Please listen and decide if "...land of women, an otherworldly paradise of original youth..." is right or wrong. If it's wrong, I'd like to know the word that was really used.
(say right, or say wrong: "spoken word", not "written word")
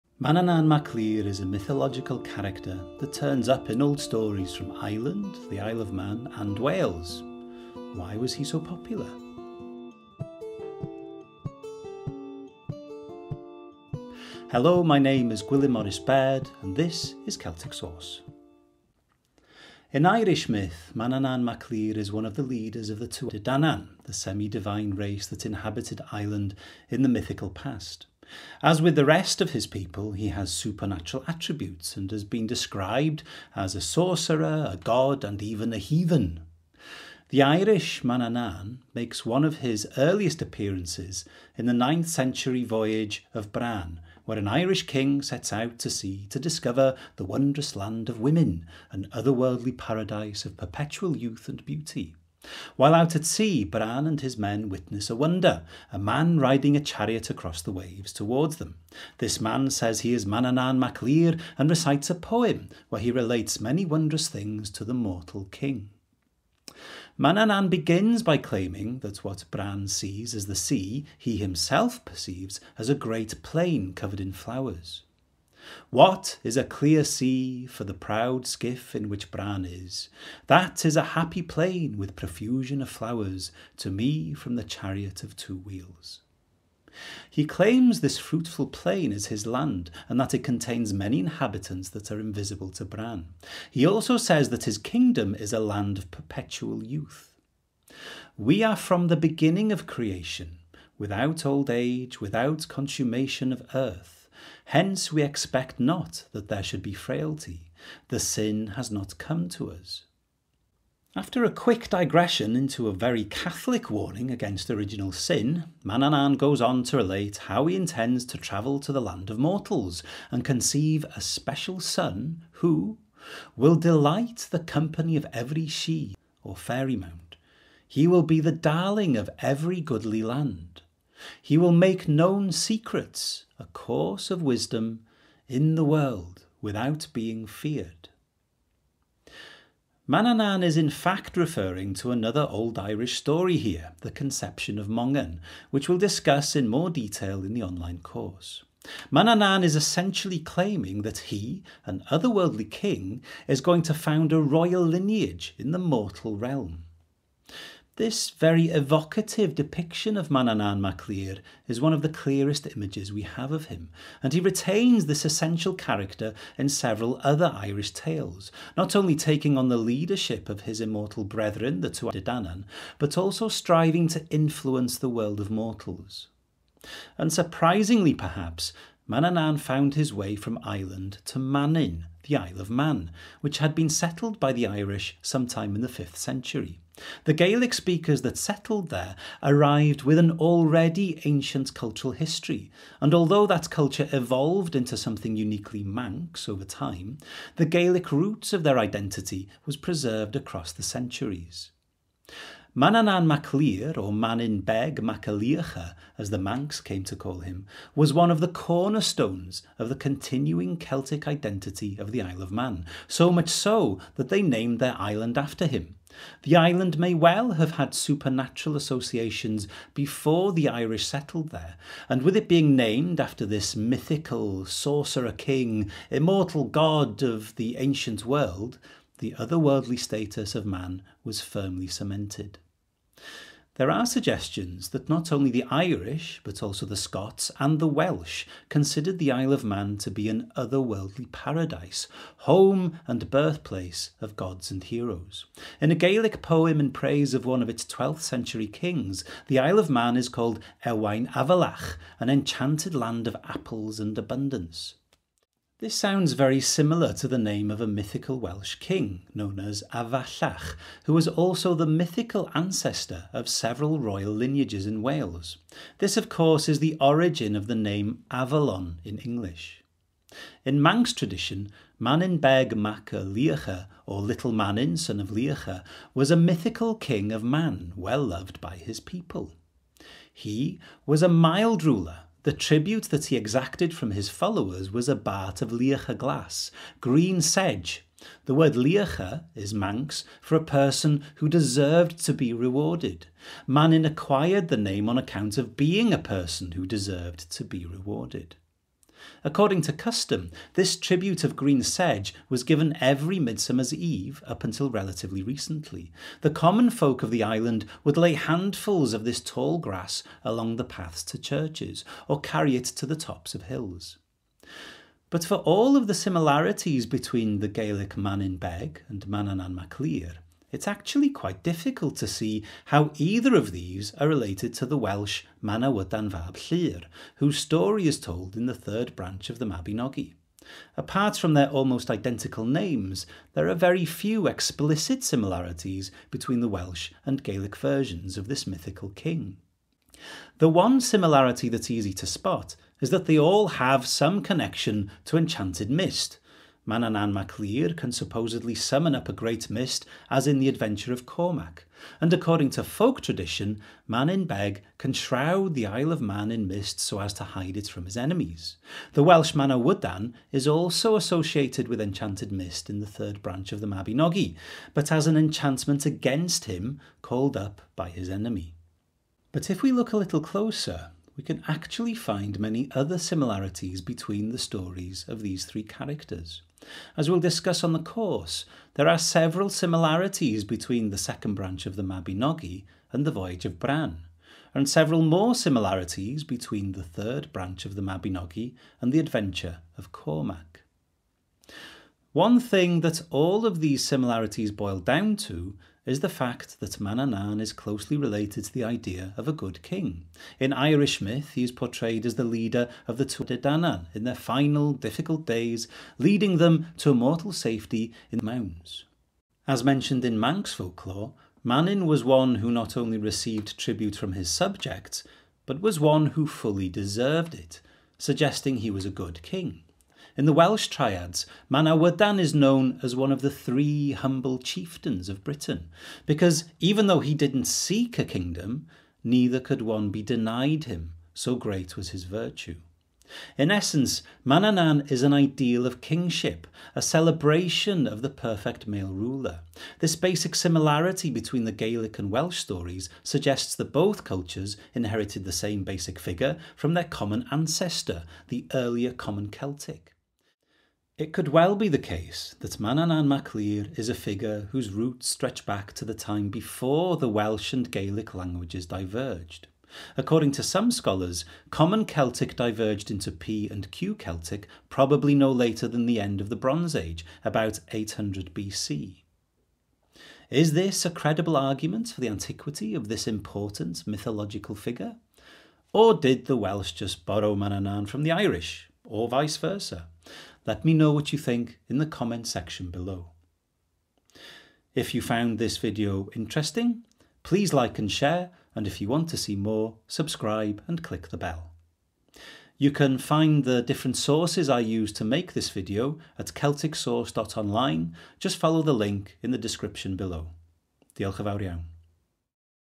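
wrong: "perpetual", not "original".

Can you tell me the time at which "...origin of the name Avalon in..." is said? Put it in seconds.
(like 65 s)
267 s.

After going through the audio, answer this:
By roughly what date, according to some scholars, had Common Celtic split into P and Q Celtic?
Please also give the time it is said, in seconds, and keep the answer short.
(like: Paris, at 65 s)
800 BC, at 467 s.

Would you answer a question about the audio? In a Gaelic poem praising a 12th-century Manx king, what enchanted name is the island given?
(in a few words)
Ewain Avalach.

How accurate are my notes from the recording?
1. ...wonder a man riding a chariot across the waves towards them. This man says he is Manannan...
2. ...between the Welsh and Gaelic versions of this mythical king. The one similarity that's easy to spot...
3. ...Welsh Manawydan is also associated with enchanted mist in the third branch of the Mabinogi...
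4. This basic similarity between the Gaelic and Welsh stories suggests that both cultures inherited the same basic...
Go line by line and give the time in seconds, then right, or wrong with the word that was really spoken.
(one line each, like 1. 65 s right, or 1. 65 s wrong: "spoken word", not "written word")
1. 55 s right
2. 336 s right
3. 359 s right
4. 439 s right.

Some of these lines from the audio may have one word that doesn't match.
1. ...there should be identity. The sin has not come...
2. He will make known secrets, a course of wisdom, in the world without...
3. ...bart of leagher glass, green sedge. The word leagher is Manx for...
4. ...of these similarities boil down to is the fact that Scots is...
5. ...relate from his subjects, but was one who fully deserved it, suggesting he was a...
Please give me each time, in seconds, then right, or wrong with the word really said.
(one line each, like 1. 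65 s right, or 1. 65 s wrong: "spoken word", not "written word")
1. 106 s wrong: "frailty", not "identity"
2. 131 s right
3. 285 s right
4. 393 s wrong: "Manannan", not "Scots"
5. 413 s wrong: "tribute", not "relate".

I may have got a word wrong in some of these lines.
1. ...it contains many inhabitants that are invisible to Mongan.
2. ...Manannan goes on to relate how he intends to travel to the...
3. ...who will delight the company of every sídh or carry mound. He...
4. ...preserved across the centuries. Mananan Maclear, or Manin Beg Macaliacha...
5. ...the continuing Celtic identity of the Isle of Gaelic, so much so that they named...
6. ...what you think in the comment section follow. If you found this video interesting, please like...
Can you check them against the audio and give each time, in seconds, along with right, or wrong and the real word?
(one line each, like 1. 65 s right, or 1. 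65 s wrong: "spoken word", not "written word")
1. 90 s wrong: "Bran", not "Mongan"
2. 115 s right
3. 122 s wrong: "fairy", not "carry"
4. 199 s right
5. 209 s wrong: "Man", not "Gaelic"
6. 481 s wrong: "below", not "follow".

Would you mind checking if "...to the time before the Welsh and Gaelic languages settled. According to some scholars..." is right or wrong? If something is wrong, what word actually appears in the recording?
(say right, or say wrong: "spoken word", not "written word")
wrong: "diverged", not "settled".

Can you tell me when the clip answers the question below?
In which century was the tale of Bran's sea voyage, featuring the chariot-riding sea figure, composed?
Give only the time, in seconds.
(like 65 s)
41 s.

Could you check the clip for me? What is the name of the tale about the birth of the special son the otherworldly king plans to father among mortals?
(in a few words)
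The conception of Mongan.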